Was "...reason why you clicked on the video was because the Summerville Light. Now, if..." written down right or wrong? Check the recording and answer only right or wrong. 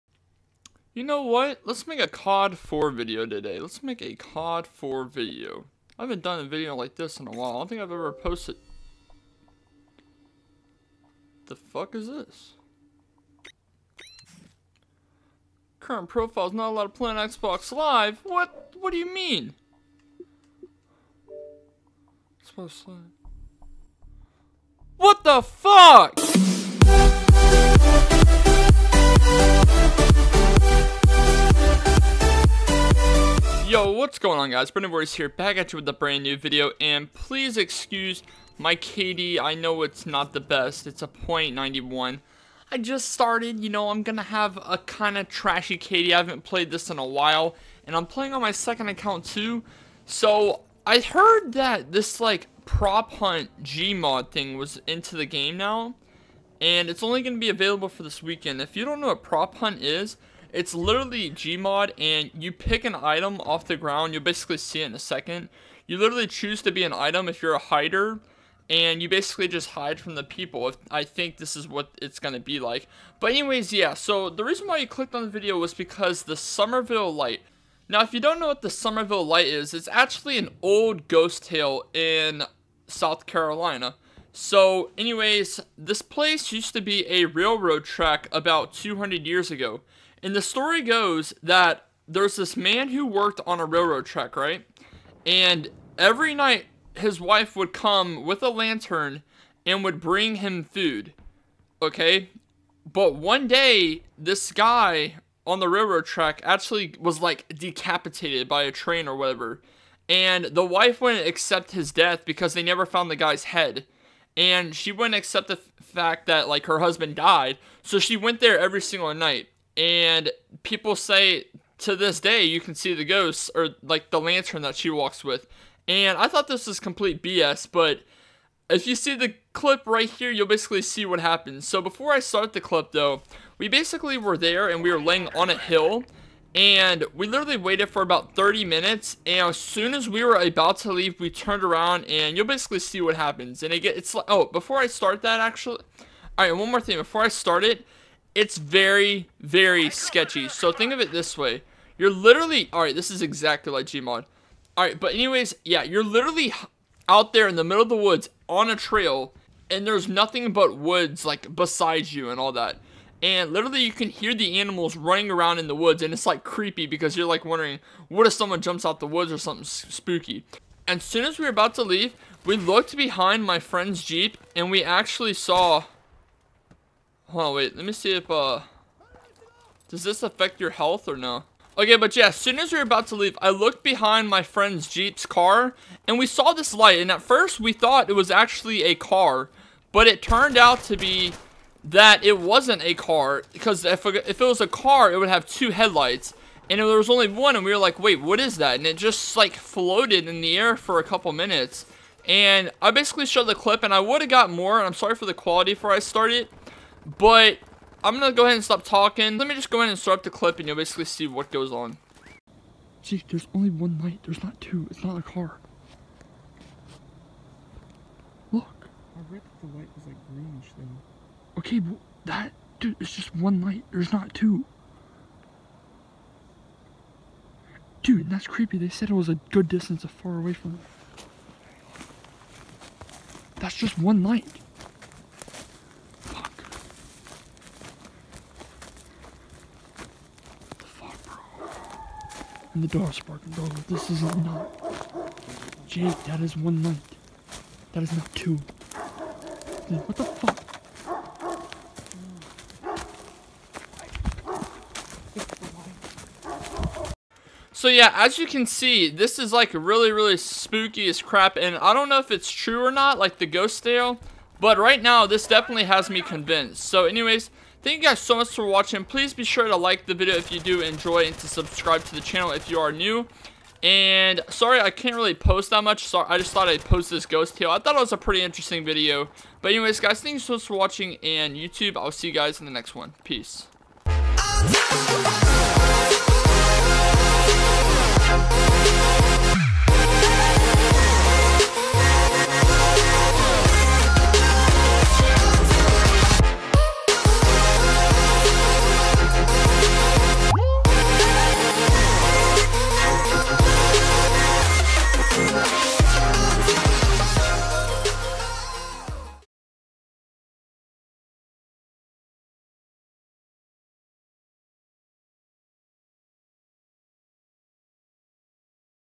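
right.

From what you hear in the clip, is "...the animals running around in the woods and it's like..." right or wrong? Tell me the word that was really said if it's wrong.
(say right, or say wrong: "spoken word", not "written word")
right.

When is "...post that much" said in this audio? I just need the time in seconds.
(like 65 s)
275 s.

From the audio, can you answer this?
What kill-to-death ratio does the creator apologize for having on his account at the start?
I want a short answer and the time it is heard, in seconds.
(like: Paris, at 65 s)
0.91, at 41 s.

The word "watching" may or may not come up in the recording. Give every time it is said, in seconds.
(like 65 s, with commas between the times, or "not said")
268 s, 280 s.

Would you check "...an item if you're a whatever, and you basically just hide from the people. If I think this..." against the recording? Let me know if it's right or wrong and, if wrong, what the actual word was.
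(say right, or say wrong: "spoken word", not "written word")
wrong: "hider", not "whatever".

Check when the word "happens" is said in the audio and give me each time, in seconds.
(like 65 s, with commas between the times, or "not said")
131 s, 143 s.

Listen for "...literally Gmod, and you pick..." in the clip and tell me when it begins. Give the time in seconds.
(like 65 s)
60 s.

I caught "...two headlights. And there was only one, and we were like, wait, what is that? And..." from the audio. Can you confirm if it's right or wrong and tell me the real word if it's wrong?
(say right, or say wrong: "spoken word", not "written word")
right.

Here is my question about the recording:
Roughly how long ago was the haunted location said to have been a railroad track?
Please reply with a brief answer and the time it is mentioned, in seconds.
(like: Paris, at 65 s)
200 years, at 88 s.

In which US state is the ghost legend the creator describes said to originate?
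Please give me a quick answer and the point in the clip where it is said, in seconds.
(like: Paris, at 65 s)
South Carolina, at 82 s.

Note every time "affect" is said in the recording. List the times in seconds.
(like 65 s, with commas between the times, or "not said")
180 s.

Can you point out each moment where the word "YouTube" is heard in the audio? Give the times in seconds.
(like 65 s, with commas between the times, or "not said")
281 s.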